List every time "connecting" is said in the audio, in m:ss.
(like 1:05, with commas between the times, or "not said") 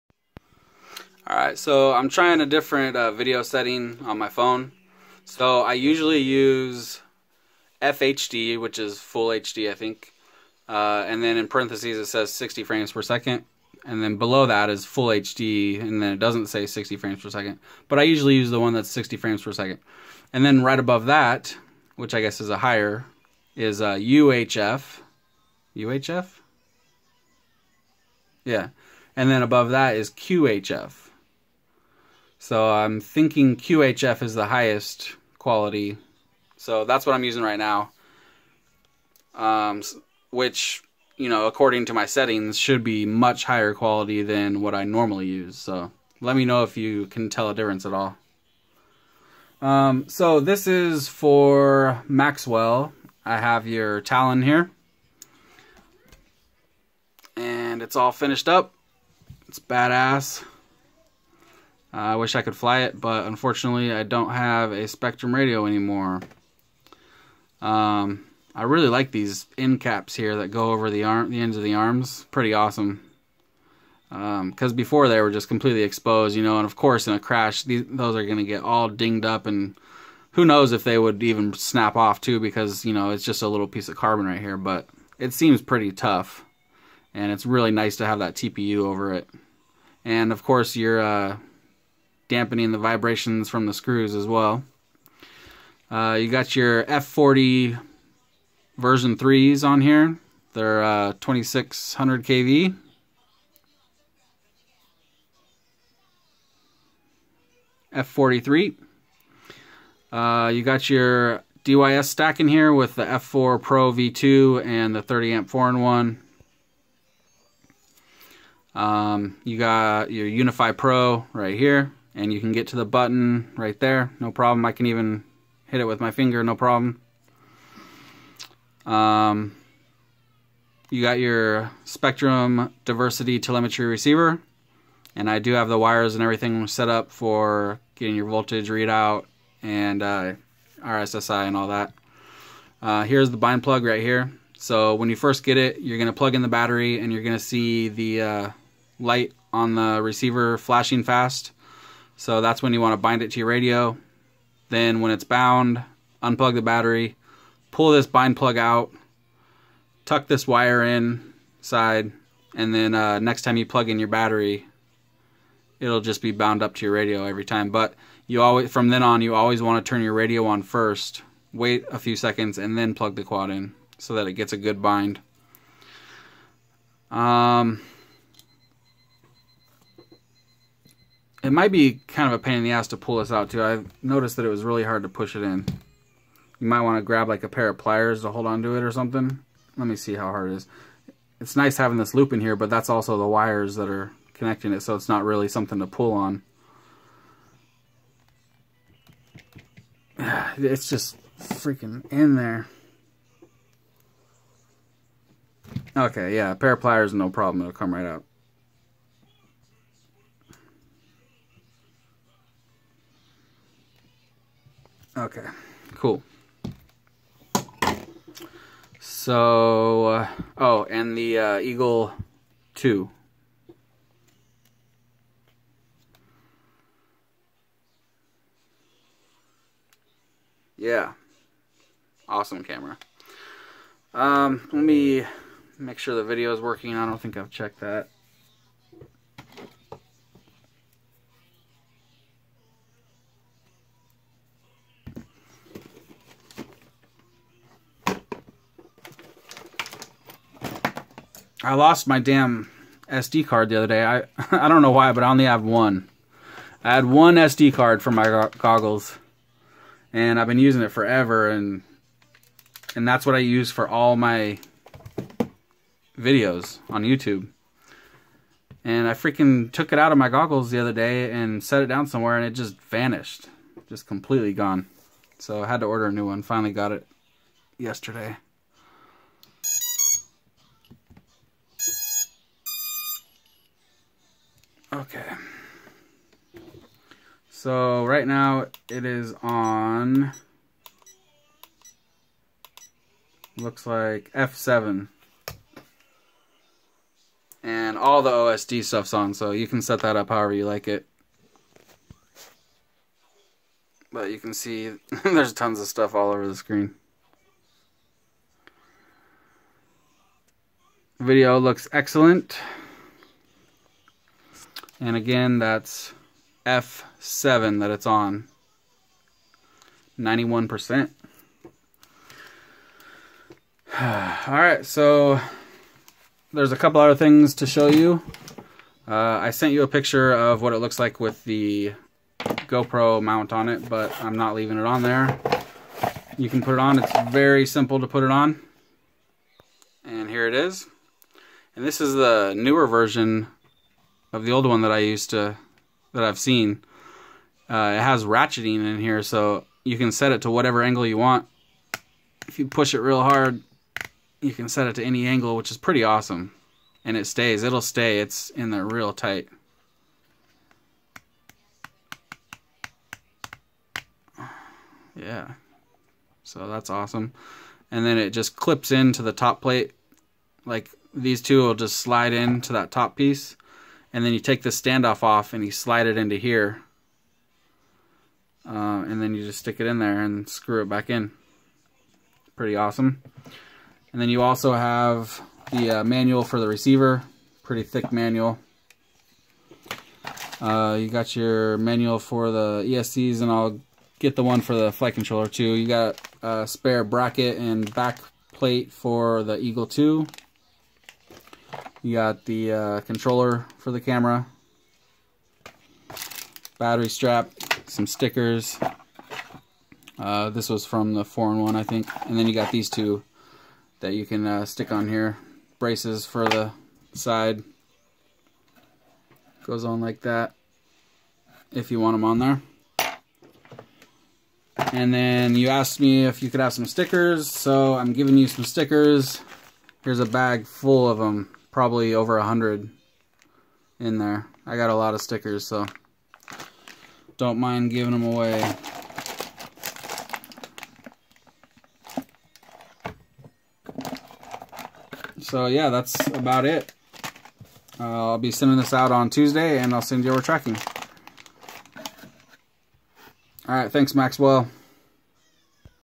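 3:14.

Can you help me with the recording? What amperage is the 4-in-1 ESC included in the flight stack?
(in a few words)
30 amp.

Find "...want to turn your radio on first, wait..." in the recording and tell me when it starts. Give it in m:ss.
2:49.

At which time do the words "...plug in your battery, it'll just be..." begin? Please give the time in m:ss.
2:43.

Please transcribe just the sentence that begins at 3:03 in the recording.
I noticed that it was really hard to push it in.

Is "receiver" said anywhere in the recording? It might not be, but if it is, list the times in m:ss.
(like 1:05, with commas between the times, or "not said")
2:13, 2:30, 6:26.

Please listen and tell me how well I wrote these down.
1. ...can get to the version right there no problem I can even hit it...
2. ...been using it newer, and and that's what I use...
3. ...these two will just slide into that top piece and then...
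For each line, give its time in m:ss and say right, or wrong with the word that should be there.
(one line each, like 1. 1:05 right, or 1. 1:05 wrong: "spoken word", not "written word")
1. 2:02 wrong: "button", not "version"
2. 4:20 wrong: "forever", not "newer"
3. 6:11 right.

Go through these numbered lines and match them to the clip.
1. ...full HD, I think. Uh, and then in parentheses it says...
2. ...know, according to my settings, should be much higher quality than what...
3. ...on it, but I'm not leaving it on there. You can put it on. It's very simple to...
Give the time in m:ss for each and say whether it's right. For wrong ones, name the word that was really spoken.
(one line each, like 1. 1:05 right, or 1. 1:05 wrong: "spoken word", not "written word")
1. 0:08 right
2. 0:41 right
3. 5:33 right.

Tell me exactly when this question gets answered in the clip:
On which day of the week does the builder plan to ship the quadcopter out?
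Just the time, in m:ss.
7:29.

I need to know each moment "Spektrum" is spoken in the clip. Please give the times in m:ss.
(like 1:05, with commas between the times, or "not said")
1:04, 2:11.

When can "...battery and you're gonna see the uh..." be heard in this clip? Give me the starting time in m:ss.
2:26.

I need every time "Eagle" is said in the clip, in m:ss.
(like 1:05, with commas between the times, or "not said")
3:41, 6:39.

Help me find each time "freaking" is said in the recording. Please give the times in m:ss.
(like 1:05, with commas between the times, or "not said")
3:21, 4:29.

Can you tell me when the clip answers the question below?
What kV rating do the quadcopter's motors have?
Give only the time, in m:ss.
1:41.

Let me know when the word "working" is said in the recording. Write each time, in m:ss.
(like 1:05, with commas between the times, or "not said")
3:56.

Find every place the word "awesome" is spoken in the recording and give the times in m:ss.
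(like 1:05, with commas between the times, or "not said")
1:12, 3:52, 5:56, 6:06, 6:22.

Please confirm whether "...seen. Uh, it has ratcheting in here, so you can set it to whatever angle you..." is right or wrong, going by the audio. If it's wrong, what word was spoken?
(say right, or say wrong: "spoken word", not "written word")
right.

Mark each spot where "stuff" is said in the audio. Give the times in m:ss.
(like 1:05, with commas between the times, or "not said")
4:58, 5:05.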